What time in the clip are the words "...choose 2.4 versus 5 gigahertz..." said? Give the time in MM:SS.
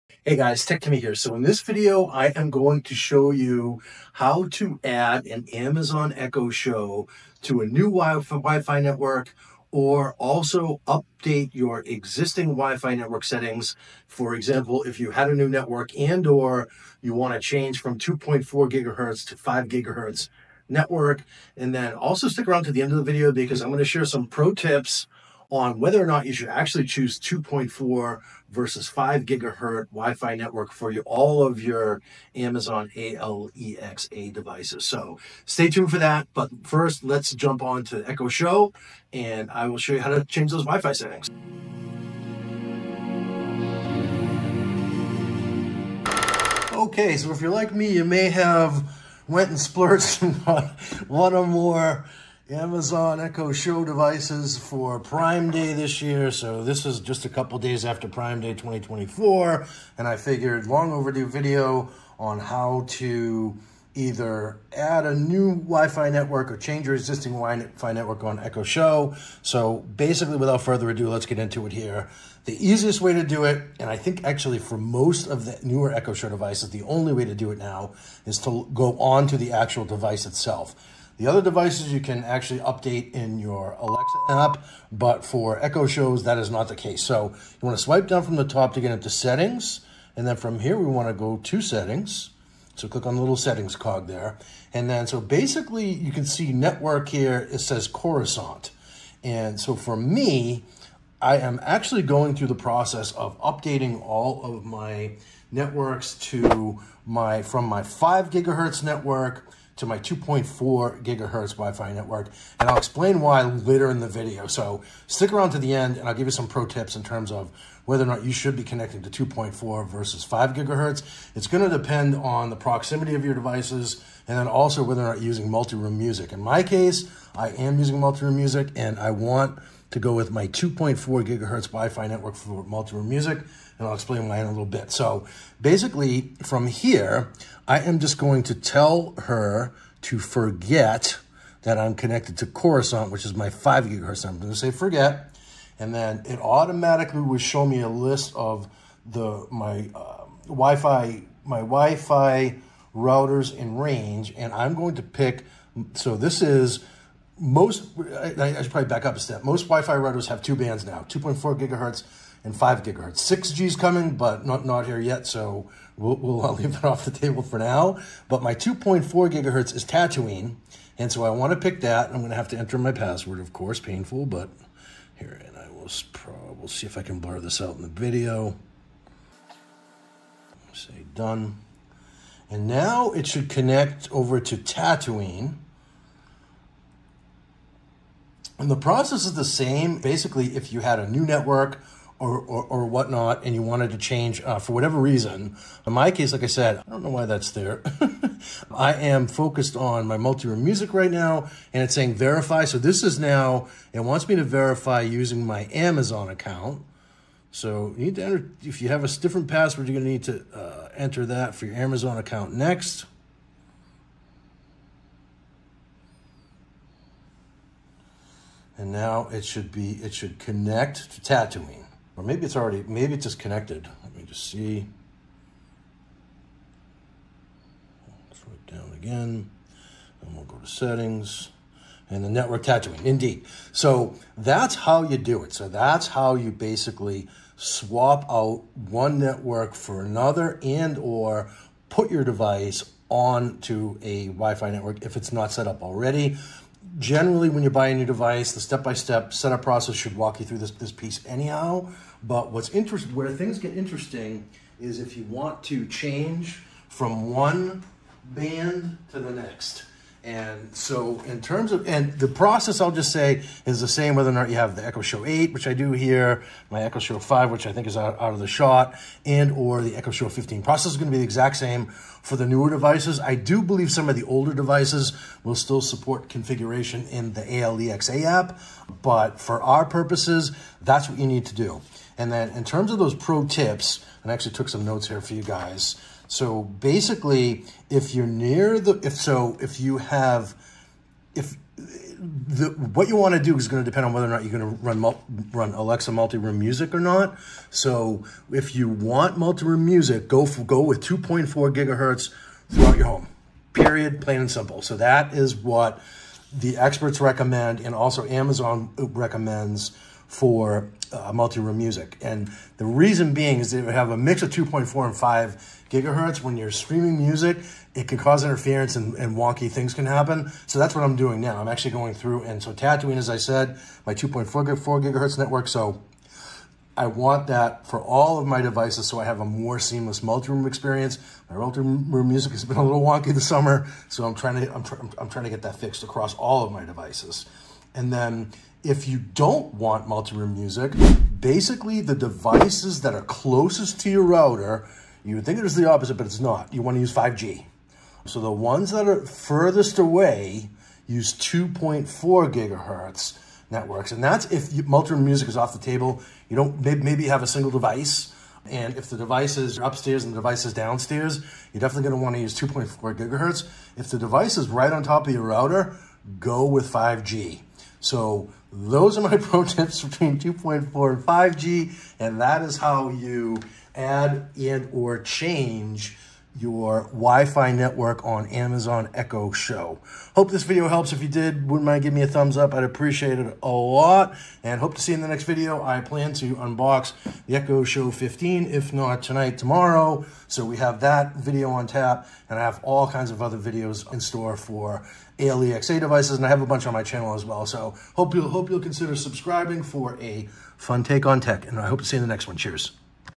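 00:26.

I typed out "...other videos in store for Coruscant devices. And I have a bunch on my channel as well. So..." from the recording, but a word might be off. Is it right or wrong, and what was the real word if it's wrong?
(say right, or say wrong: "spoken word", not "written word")
wrong: "ALEXA", not "Coruscant".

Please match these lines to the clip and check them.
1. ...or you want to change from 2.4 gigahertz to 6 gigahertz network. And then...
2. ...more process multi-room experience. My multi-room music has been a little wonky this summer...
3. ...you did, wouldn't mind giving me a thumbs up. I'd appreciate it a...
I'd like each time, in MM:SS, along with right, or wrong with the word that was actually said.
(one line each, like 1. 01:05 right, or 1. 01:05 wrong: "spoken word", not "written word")
1. 00:16 wrong: "5", not "6"
2. 05:29 wrong: "seamless", not "process"
3. 06:21 right.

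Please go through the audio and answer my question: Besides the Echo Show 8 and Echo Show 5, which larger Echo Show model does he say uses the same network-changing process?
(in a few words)
Echo Show 15.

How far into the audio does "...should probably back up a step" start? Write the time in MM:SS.
02:38.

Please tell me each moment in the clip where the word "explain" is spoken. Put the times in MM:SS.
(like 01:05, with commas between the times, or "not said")
01:52, 02:13.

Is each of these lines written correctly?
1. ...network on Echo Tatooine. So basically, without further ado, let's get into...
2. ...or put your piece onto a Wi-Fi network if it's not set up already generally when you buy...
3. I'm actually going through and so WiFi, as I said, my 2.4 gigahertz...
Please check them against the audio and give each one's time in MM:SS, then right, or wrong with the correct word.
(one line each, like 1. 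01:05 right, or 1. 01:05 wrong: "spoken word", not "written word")
1. 01:07 wrong: "Show", not "Tatooine"
2. 04:00 wrong: "device", not "piece"
3. 05:21 wrong: "Tatooine", not "WiFi".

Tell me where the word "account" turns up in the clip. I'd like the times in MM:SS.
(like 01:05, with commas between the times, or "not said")
03:26, 03:32.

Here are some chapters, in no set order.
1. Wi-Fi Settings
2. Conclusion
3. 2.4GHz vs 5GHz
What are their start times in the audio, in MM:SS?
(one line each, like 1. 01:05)
1. 01:10
2. 06:07
3. 04:40.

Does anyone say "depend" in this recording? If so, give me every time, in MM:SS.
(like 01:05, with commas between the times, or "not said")
02:01, 04:53.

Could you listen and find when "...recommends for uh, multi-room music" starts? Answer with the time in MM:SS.
05:08.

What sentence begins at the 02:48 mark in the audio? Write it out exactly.
But my 2.4 gigahertz is Tatooine, and so I want to pick that.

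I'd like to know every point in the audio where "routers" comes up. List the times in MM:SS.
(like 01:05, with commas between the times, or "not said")
02:32, 02:39, 05:44, 06:05.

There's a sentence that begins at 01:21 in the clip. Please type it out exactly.
The other devices you can actually update in your Alexa app, but for Echo shows, that is not the case.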